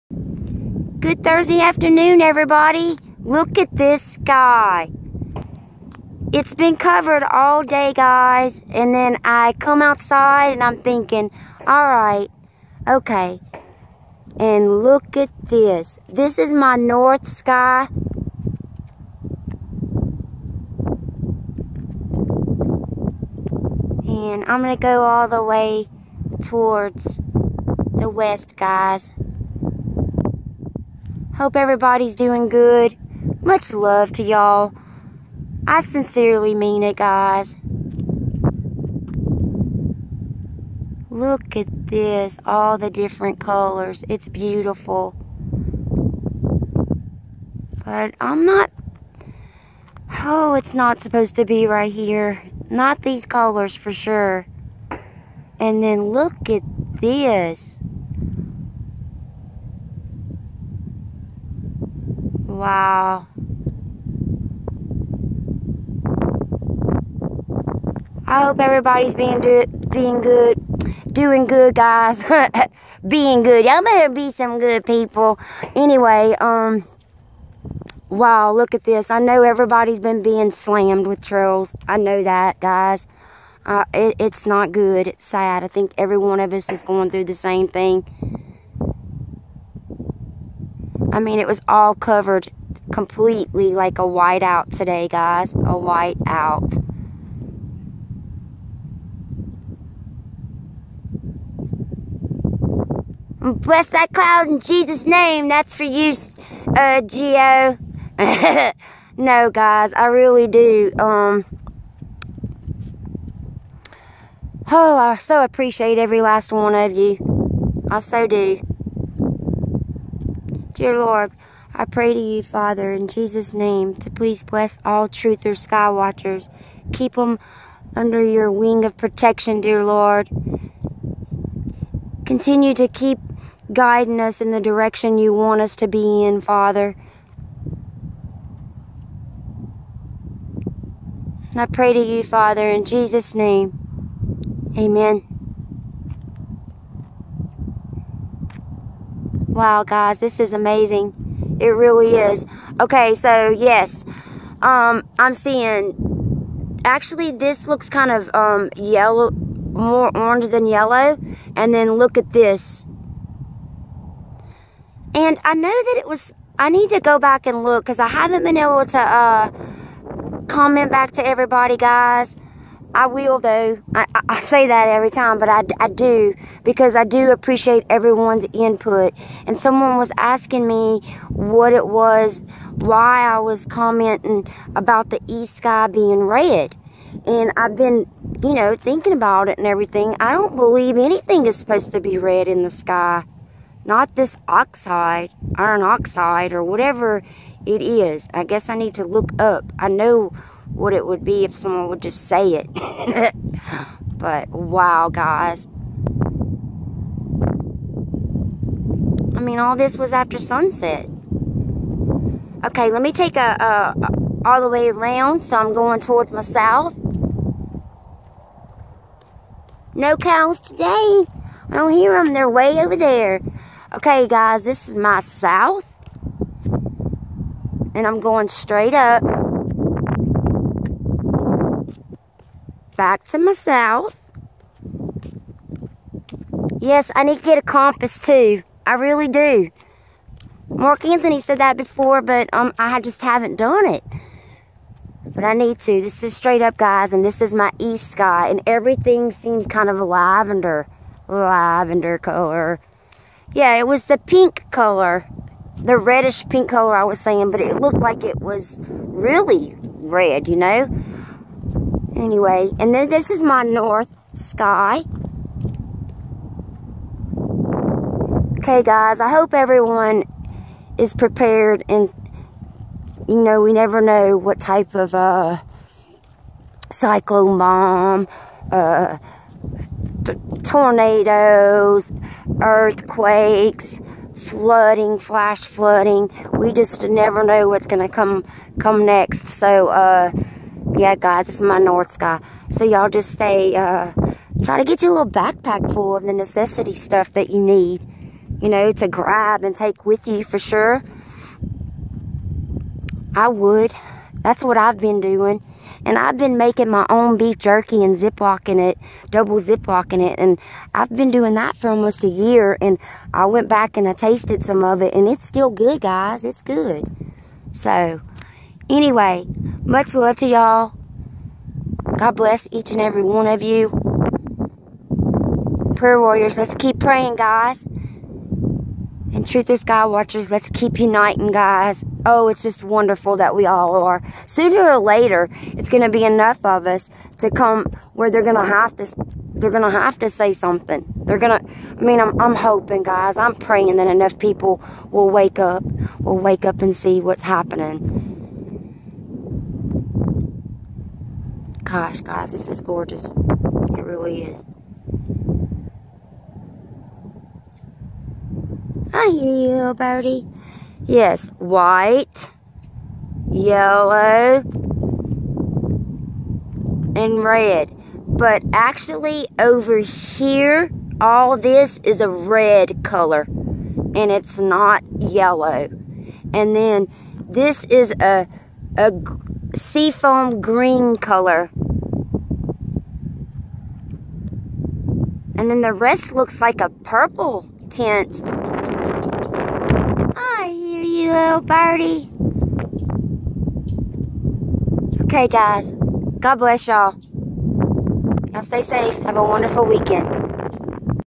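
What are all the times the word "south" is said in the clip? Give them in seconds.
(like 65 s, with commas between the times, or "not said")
216 s, 225 s, 233 s.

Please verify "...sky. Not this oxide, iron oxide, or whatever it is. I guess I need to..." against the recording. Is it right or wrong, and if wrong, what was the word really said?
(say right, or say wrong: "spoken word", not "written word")
right.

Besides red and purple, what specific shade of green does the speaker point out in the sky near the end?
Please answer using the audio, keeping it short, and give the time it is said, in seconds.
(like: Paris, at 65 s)
seafoam green, at 379 s.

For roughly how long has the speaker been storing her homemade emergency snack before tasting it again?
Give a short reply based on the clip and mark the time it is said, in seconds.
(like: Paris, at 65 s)
almost a year, at 311 s.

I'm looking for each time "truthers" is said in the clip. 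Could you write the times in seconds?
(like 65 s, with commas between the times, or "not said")
125 s, 329 s.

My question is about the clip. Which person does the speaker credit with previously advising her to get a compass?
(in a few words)
Mark Anthony.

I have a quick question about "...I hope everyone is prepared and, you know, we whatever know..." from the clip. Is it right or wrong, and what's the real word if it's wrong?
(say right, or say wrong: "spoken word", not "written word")
wrong: "never", not "whatever".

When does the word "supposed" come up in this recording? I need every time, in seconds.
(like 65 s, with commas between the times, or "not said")
51 s, 191 s.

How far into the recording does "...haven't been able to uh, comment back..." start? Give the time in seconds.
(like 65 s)
168 s.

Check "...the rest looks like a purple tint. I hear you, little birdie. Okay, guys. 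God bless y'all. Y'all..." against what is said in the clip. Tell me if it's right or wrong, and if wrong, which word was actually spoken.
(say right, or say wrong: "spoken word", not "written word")
right.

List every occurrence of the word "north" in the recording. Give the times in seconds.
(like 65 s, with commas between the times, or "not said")
16 s, 263 s, 291 s.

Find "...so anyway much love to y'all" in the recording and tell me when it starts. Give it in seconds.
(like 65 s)
317 s.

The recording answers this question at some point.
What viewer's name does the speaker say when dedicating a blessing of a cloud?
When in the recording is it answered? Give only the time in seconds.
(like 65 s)
107 s.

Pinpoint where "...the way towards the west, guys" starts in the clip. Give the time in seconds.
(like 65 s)
25 s.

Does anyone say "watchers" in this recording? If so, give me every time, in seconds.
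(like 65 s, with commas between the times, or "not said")
125 s, 330 s.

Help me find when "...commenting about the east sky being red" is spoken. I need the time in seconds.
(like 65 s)
183 s.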